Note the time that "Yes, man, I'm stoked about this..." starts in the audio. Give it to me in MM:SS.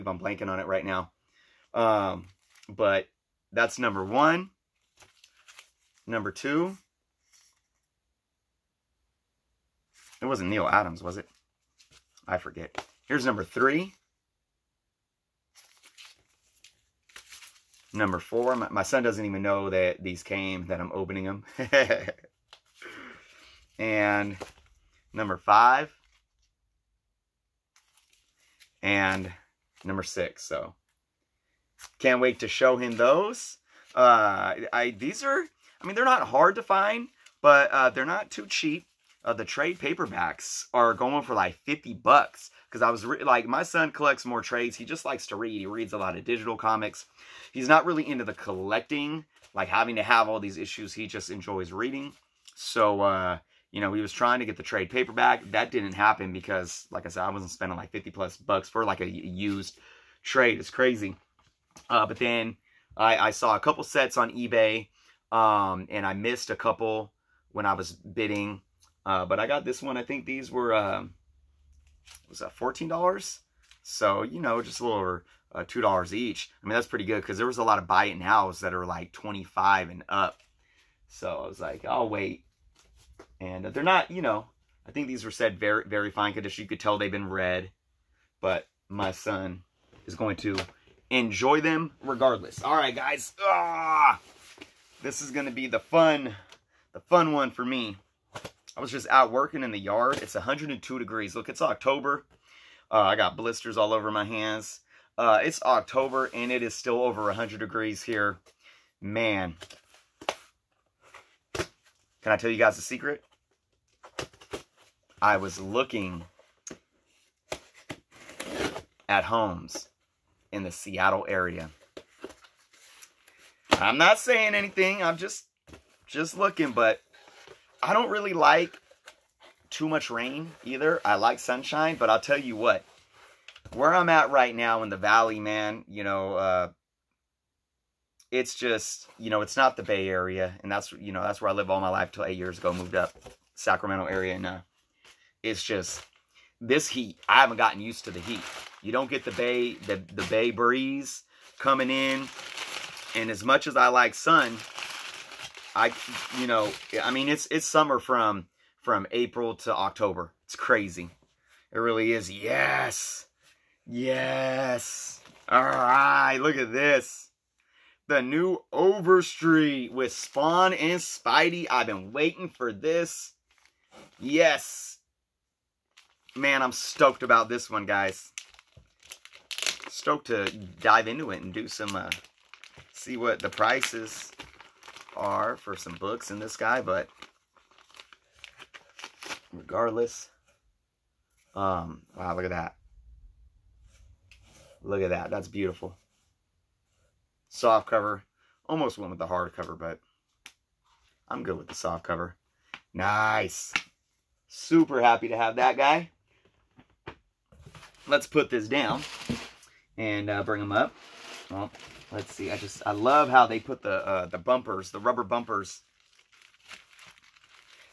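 02:54.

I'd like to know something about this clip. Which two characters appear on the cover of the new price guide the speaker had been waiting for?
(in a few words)
Spawn and Spidey.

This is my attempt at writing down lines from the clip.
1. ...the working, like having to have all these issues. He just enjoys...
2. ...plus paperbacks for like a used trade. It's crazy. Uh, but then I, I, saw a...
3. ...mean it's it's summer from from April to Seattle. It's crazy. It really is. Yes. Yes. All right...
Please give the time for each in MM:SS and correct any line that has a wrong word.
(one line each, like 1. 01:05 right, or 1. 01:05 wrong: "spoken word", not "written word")
1. 00:48 wrong: "collecting", not "working"
2. 00:58 wrong: "bucks", not "paperbacks"
3. 02:37 wrong: "October", not "Seattle".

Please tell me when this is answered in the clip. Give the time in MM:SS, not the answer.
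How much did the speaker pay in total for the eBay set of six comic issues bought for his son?
01:12.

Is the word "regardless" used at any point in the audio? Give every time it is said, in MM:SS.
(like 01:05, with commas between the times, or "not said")
01:32, 03:09.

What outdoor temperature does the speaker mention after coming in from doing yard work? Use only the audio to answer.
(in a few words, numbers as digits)
102 degrees.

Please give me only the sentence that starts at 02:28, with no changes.
You don't get the bay the, the bay breeze coming in.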